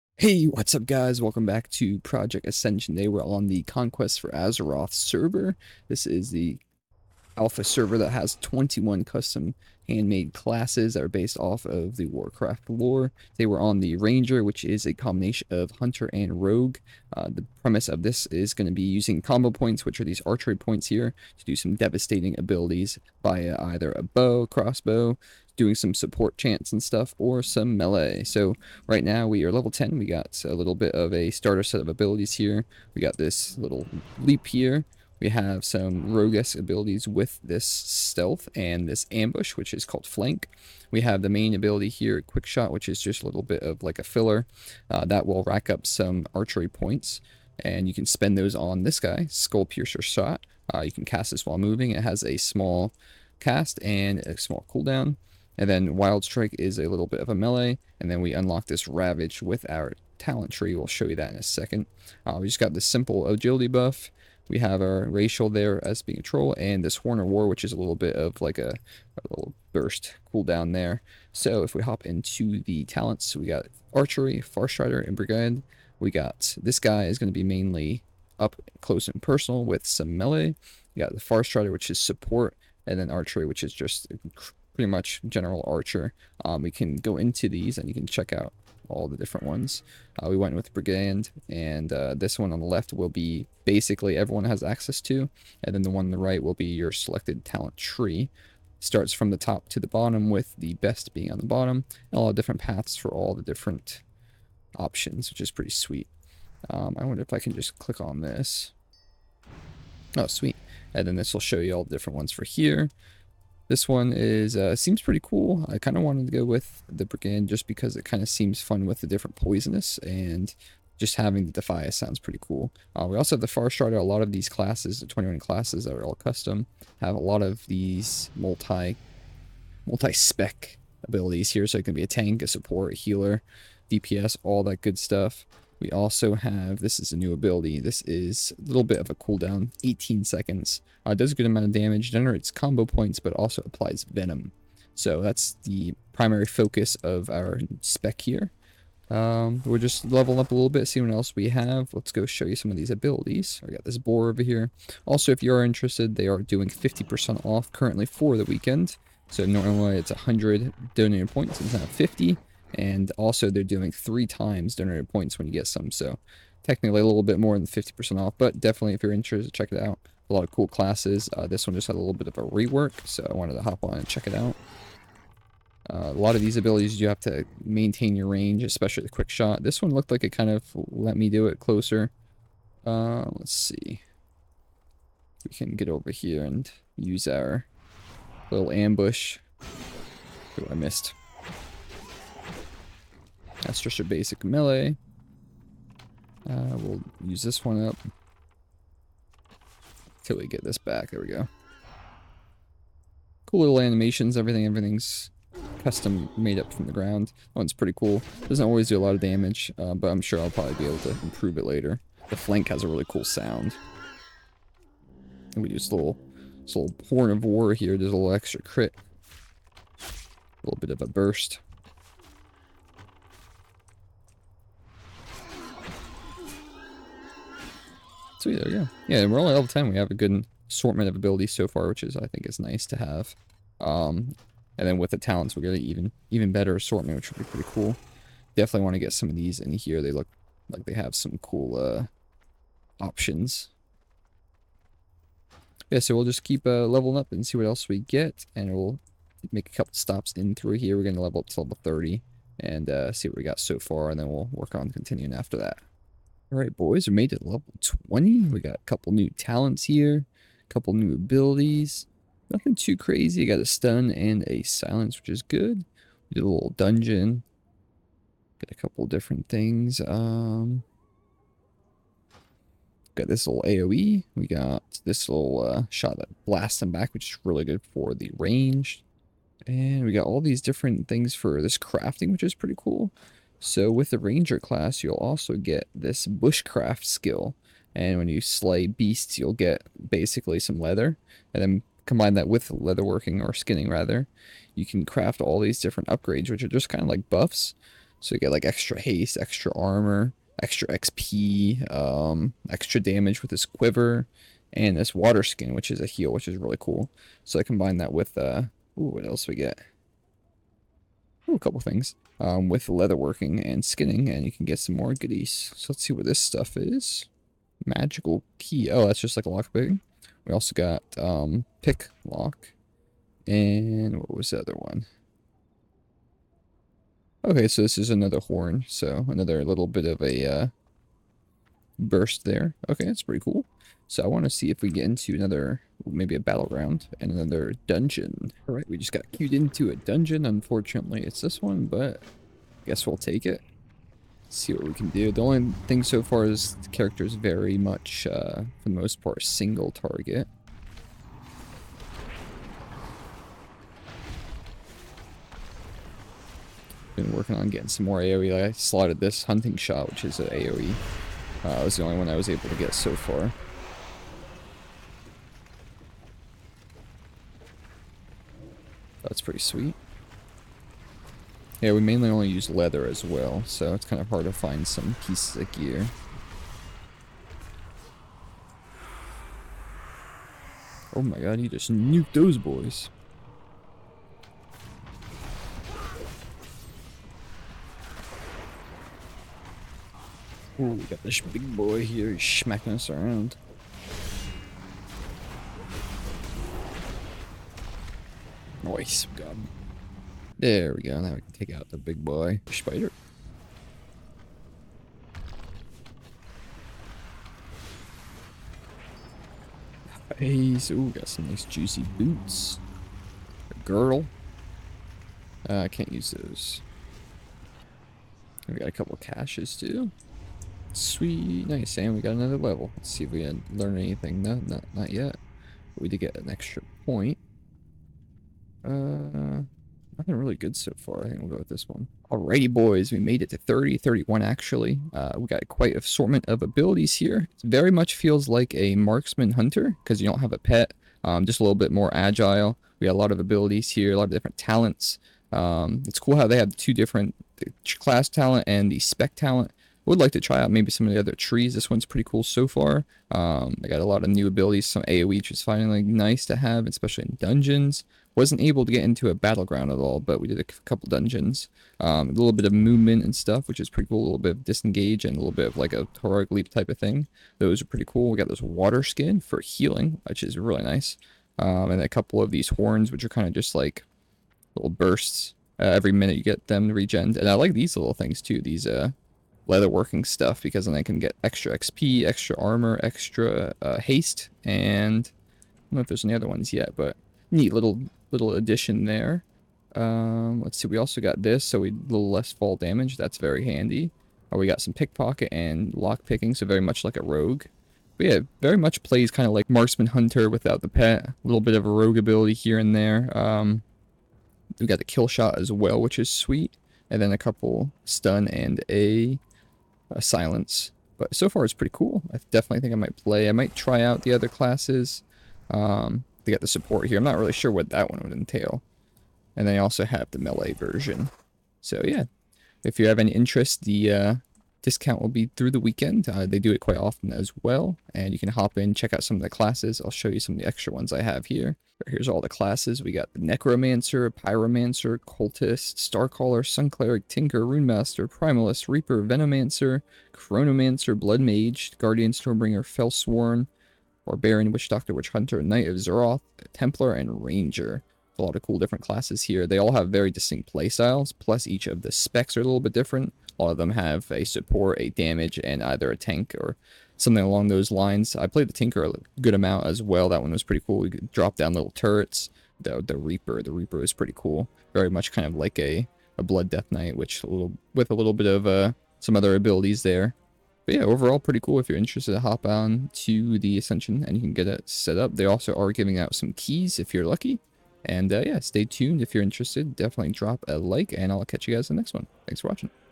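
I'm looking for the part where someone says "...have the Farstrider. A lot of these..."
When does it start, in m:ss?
2:03.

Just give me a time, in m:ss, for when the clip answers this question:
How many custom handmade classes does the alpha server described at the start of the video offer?
0:08.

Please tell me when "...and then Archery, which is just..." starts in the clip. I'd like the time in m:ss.
1:22.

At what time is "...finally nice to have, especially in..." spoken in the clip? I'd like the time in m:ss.
7:35.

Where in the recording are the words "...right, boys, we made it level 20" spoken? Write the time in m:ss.
4:16.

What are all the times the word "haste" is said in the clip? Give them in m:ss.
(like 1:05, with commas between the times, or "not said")
4:58, 8:03.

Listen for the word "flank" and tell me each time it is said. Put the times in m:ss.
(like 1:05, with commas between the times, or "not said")
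0:40, 3:32.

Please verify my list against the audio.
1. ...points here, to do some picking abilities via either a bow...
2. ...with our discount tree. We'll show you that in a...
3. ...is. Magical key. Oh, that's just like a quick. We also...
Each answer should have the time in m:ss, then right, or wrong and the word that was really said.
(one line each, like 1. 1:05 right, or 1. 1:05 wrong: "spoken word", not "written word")
1. 0:20 wrong: "devastating", not "picking"
2. 0:59 wrong: "talent", not "discount"
3. 5:16 wrong: "lockpick", not "quick".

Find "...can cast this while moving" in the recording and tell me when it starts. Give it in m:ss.
0:50.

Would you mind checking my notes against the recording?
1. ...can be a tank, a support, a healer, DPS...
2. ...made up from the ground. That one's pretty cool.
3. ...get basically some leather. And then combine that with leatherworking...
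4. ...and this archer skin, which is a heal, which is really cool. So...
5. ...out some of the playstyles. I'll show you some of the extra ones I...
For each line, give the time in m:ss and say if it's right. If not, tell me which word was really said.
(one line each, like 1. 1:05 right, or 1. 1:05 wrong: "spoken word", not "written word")
1. 2:11 right
2. 3:26 right
3. 4:49 right
4. 5:04 wrong: "water", not "archer"
5. 8:49 wrong: "classes", not "playstyles".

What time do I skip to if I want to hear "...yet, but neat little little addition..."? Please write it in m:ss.
8:06.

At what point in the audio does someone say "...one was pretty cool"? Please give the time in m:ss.
9:20.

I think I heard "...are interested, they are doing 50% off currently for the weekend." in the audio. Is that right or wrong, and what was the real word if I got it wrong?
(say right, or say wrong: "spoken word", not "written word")
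right.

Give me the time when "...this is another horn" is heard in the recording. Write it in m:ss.
5:27.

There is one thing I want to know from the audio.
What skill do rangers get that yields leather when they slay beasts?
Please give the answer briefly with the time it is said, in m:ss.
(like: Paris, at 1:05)
Bushcraft, at 4:46.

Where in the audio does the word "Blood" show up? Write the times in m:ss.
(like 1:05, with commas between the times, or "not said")
9:01, 9:26.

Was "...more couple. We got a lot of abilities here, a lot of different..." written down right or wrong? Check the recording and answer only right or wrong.
wrong.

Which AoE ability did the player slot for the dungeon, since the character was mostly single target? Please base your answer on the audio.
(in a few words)
Hunting shot.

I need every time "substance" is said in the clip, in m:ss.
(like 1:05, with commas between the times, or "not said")
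not said.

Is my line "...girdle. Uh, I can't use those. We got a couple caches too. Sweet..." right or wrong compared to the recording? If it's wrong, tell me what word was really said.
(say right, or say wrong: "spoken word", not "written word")
right.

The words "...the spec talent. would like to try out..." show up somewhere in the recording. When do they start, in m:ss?
7:28.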